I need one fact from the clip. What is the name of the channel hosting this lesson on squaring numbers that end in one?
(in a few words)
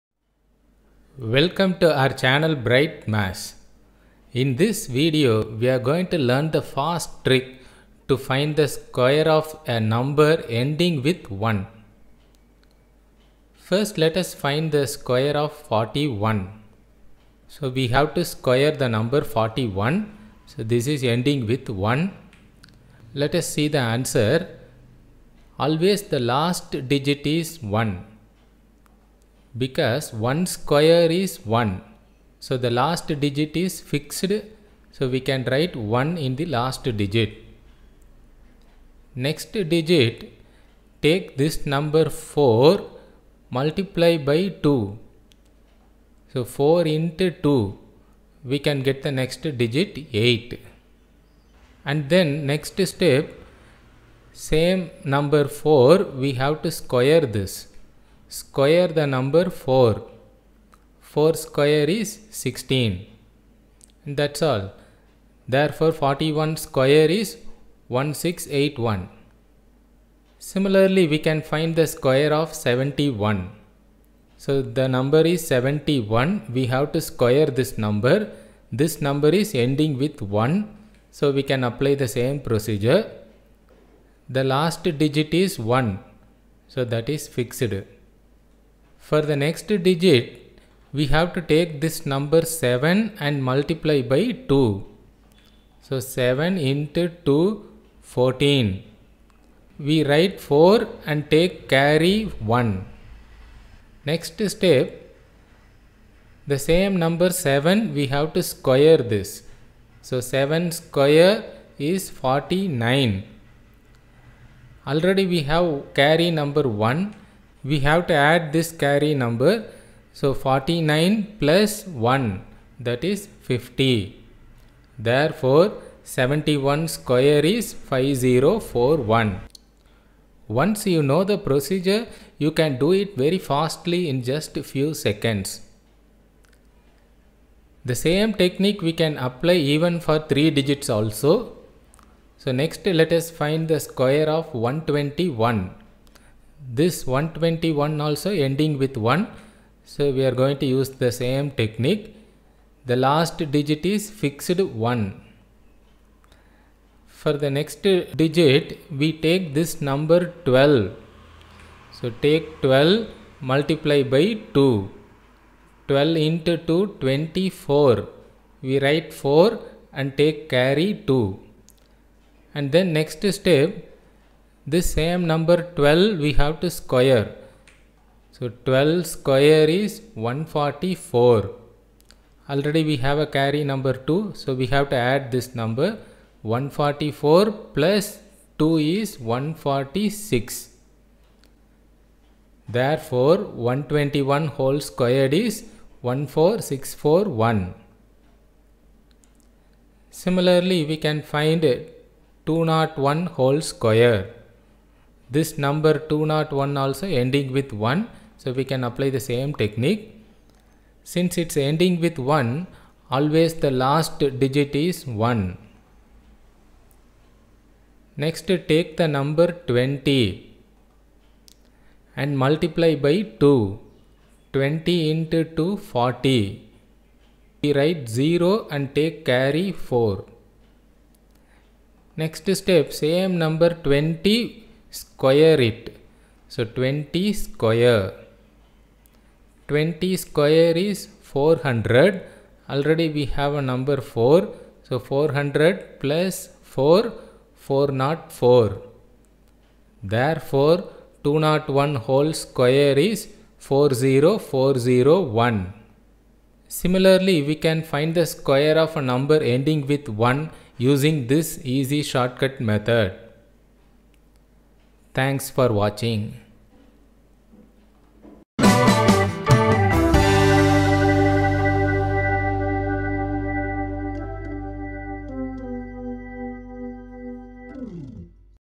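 Bright Maths.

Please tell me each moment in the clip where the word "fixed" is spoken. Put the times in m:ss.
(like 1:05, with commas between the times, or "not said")
0:33, 1:27, 2:34.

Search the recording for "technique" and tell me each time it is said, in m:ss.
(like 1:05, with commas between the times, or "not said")
2:18, 2:31, 3:29.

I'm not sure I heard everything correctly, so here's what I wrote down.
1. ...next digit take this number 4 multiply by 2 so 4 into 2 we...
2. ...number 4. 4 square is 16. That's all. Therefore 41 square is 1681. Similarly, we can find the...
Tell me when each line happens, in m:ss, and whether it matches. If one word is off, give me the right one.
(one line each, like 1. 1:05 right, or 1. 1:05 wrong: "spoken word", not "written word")
1. 0:39 right
2. 0:59 right.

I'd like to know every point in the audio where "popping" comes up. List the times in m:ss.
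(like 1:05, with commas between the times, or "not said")
not said.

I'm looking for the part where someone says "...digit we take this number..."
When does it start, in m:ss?
2:38.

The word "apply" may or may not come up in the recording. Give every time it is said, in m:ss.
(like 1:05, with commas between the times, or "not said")
1:21, 2:19, 3:28.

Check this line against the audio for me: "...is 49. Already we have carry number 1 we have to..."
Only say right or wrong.
right.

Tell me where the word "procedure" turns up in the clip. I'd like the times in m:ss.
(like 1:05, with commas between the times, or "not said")
1:22, 2:11.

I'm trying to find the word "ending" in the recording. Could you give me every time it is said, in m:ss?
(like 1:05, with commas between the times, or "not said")
0:10, 0:21, 1:19, 2:28, 3:27, 3:31, 4:19.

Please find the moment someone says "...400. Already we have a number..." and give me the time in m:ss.
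4:01.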